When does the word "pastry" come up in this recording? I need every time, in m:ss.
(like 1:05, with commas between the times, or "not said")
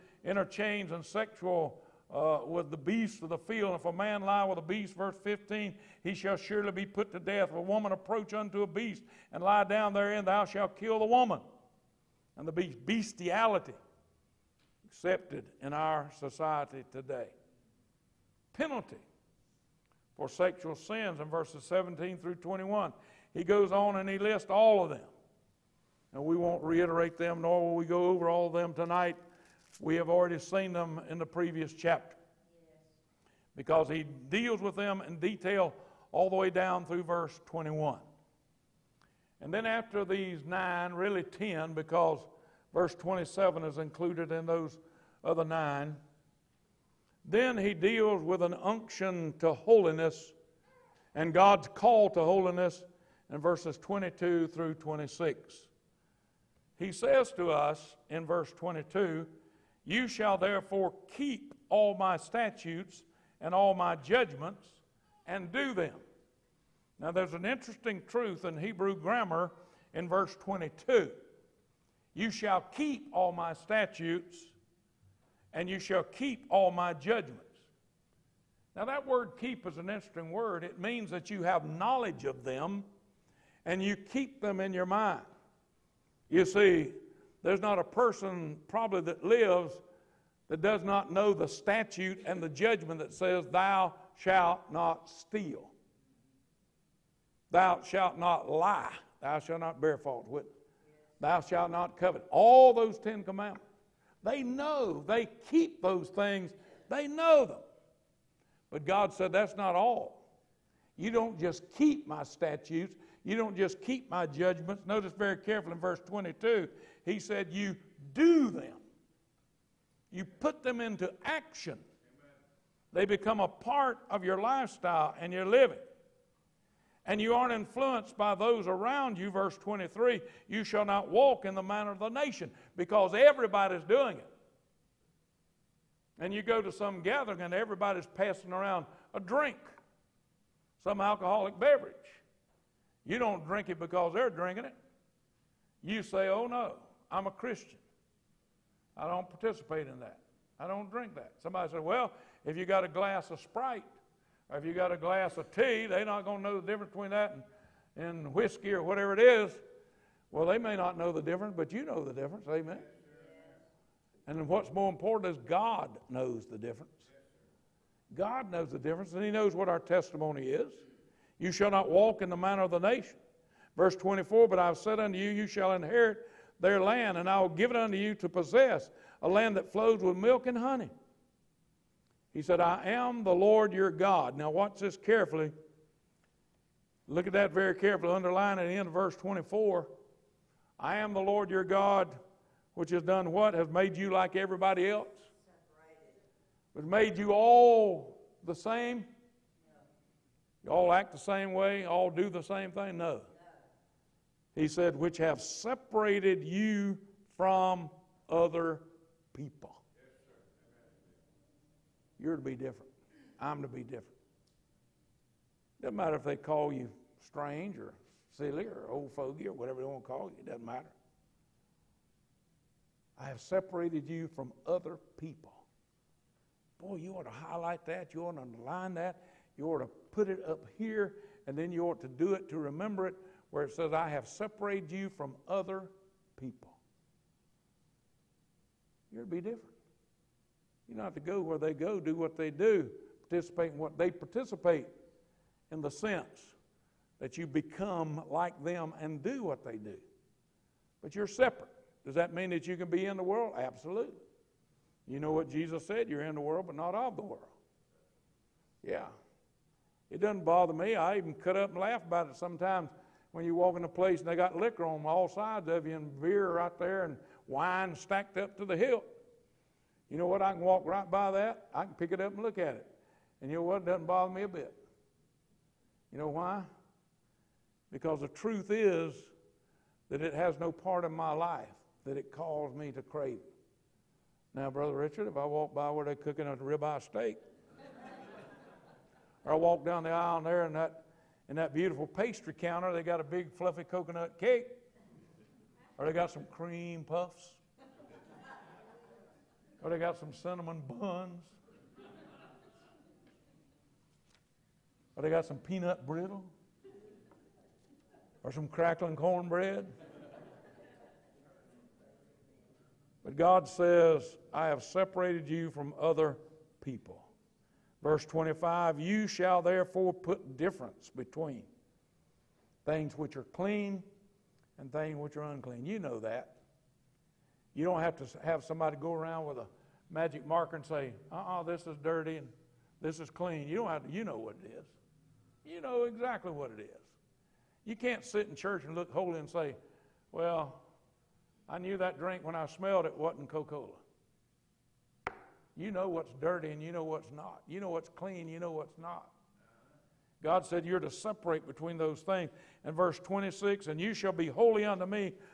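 4:52.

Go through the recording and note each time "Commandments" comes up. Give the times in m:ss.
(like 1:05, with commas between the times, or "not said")
1:43.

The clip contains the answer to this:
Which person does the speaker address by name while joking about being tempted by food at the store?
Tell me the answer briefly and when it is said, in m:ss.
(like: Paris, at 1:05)
Brother Richard, at 4:44.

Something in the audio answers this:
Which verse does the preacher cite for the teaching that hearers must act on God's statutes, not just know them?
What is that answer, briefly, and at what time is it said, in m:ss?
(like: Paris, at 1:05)
22, at 1:55.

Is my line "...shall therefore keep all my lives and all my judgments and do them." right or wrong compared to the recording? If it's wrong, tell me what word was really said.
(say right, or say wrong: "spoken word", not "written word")
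wrong: "statutes", not "lives".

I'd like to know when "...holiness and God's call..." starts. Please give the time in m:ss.
0:49.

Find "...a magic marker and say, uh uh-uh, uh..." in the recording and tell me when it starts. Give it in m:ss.
5:29.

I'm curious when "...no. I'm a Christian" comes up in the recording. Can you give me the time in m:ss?
2:26.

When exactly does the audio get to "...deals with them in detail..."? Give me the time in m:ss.
0:34.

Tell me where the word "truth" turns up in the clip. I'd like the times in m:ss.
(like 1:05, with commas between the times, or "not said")
1:08, 4:38.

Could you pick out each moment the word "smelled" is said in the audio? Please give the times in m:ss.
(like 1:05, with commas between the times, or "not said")
5:42.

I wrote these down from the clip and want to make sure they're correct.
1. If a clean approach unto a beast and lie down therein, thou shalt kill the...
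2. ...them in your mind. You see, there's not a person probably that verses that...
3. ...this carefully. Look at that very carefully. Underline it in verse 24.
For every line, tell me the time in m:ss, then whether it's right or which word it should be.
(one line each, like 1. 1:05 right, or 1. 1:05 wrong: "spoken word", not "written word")
1. 0:07 wrong: "woman", not "clean"
2. 1:24 wrong: "lives", not "verses"
3. 3:04 right.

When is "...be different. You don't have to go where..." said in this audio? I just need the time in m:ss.
3:59.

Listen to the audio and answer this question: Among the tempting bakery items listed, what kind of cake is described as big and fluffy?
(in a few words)
Coconut cake.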